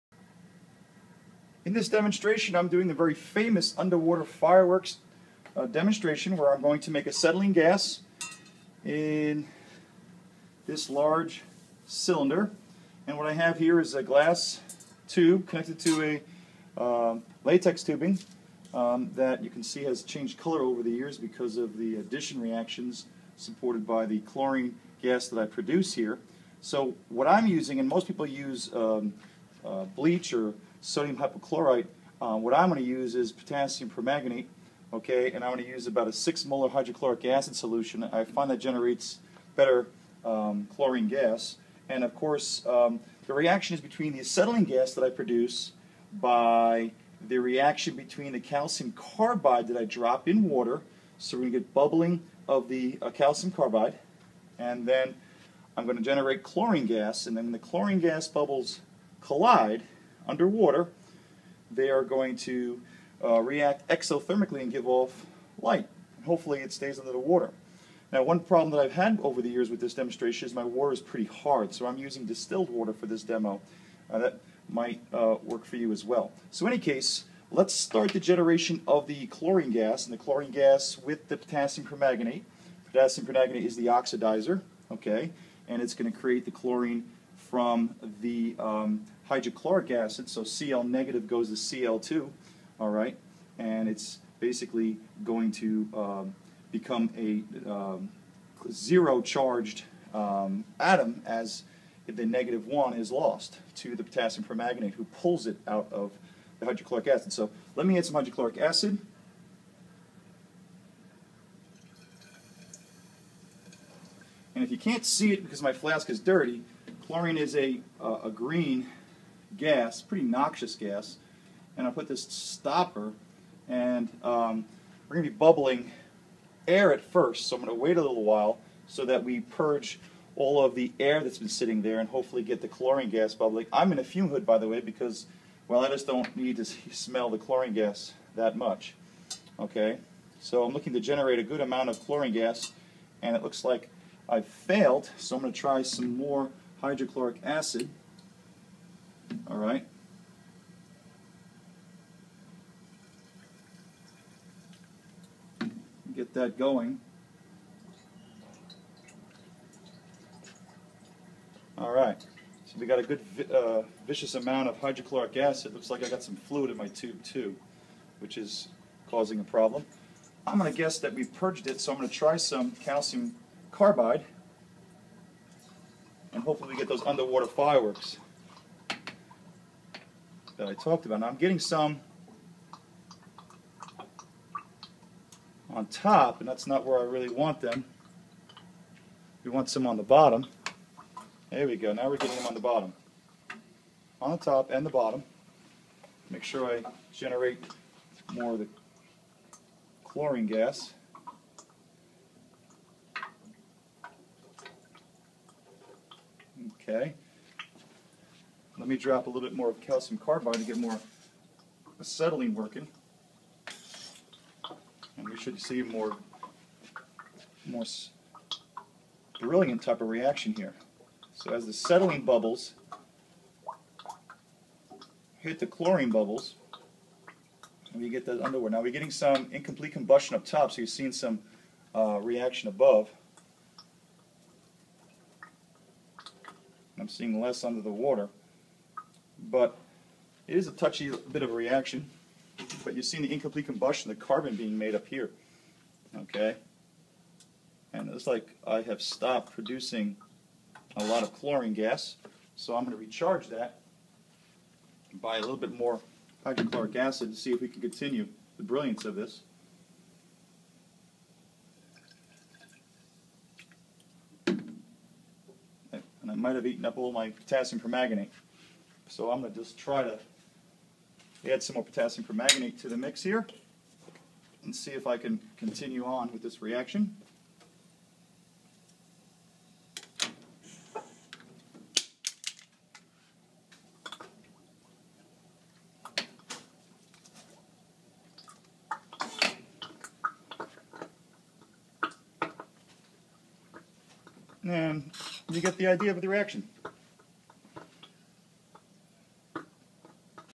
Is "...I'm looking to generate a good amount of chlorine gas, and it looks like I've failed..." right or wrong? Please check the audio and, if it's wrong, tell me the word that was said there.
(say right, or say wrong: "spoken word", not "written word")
right.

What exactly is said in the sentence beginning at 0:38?
I find that generates better um, chlorine gas.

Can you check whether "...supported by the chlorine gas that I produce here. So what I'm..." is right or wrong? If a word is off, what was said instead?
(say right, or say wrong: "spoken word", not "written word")
right.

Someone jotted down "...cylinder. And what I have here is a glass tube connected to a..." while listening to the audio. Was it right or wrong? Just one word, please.
right.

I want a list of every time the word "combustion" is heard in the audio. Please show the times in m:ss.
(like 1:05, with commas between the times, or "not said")
3:49, 4:03.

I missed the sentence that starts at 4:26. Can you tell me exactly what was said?
I might have eaten up all my potassium permanganate.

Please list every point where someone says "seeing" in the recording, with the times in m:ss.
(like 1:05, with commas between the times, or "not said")
3:50, 3:57, 4:03.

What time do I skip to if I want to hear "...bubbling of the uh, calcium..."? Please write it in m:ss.
0:51.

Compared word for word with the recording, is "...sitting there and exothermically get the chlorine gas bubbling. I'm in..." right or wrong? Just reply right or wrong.
wrong.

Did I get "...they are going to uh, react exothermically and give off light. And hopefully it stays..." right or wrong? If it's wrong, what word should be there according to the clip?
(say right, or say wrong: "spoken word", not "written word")
right.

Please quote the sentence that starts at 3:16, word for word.
Make sure I generate more of the chlorine gas.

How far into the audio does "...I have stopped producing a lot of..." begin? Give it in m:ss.
4:08.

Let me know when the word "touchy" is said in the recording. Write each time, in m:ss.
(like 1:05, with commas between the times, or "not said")
4:00.